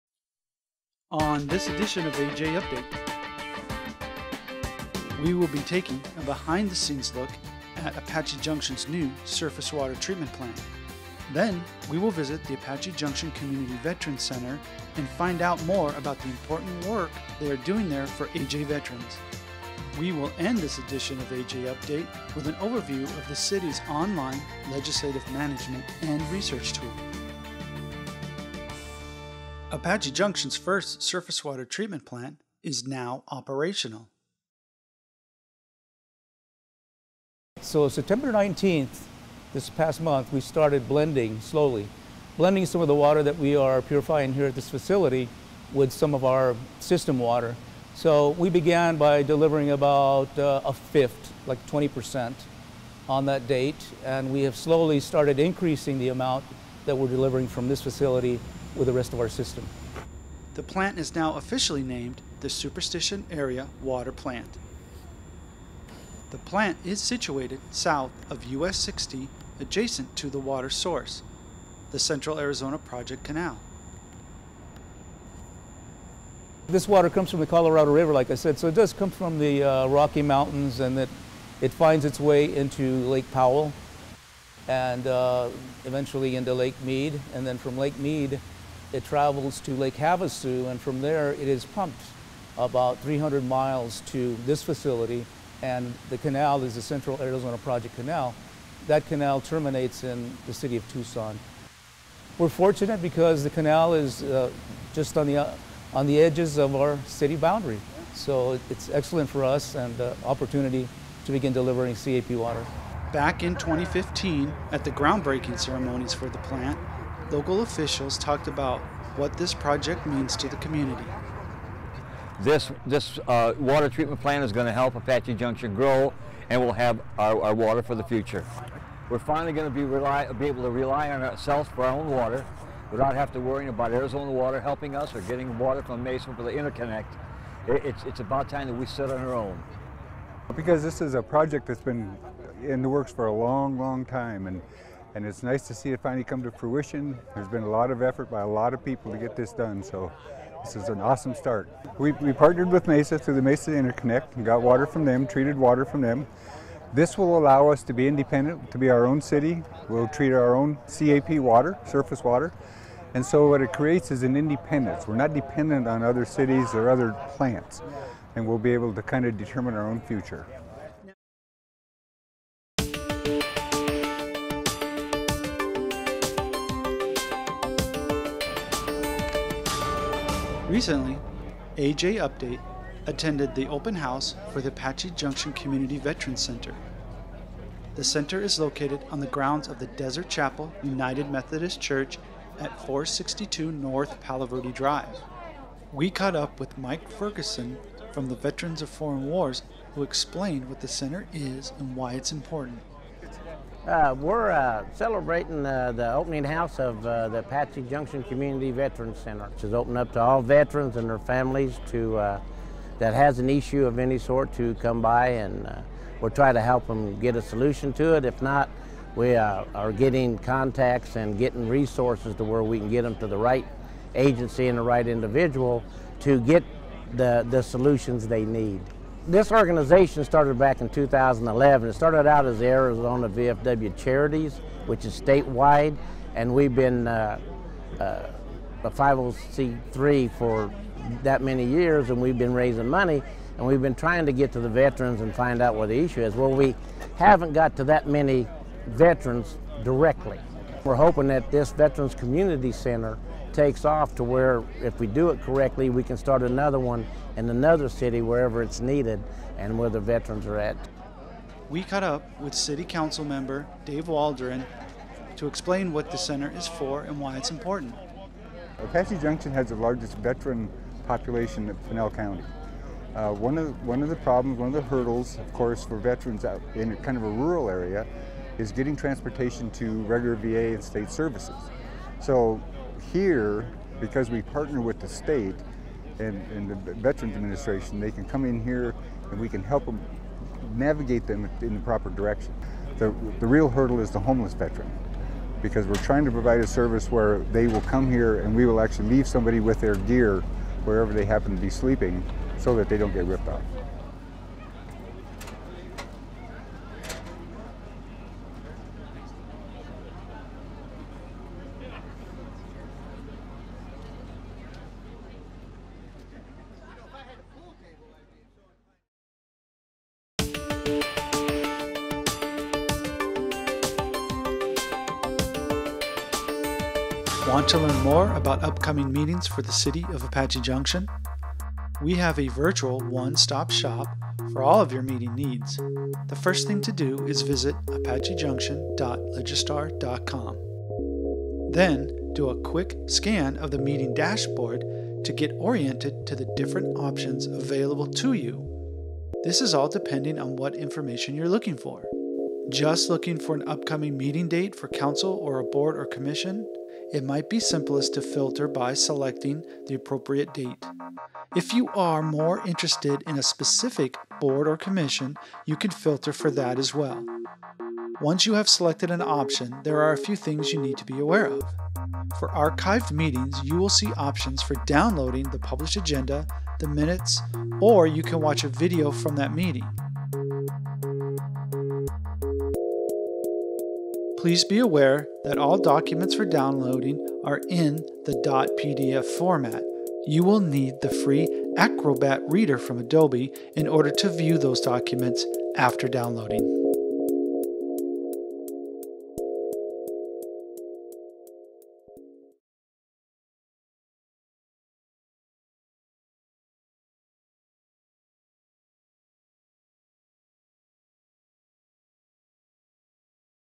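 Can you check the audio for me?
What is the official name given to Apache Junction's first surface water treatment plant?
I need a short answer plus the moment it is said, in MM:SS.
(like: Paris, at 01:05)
Superstition Area Water Plant, at 01:02.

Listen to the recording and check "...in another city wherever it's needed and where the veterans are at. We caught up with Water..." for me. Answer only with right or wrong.
wrong.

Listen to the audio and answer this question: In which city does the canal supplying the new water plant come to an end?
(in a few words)
Tucson.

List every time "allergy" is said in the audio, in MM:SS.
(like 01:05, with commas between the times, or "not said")
not said.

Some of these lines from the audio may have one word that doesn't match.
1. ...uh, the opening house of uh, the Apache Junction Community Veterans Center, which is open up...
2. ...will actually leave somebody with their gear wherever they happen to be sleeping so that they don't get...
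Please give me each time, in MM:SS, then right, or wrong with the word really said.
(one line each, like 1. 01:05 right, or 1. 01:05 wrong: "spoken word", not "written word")
1. 03:25 right
2. 04:58 right.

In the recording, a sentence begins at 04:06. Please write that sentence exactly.
Well, we haven't got to that many veterans directly.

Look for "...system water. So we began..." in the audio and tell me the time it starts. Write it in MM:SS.
00:46.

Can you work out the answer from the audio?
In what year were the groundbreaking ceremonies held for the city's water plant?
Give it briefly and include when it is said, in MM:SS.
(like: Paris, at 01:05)
2015, at 01:53.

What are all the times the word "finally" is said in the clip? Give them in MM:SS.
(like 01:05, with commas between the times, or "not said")
02:09, 02:26.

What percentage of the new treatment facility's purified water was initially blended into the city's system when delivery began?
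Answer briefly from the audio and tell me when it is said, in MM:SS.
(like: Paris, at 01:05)
20%, at 00:51.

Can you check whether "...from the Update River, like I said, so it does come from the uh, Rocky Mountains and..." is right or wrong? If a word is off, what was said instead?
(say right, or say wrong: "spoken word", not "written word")
wrong: "Colorado", not "Update".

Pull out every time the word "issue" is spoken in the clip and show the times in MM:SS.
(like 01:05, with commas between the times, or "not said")
03:33, 04:05.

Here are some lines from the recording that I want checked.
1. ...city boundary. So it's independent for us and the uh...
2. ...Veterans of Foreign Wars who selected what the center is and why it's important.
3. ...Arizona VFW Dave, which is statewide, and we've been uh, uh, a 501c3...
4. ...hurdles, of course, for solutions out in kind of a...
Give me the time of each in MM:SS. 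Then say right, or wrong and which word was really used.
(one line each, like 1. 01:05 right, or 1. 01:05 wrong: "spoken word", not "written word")
1. 01:47 wrong: "excellent", not "independent"
2. 03:18 wrong: "explained", not "selected"
3. 03:52 wrong: "Charities", not "Dave"
4. 04:34 wrong: "veterans", not "solutions".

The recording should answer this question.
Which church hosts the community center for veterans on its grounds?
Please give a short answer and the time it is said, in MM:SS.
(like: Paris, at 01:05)
Desert Chapel United Methodist Church, at 03:09.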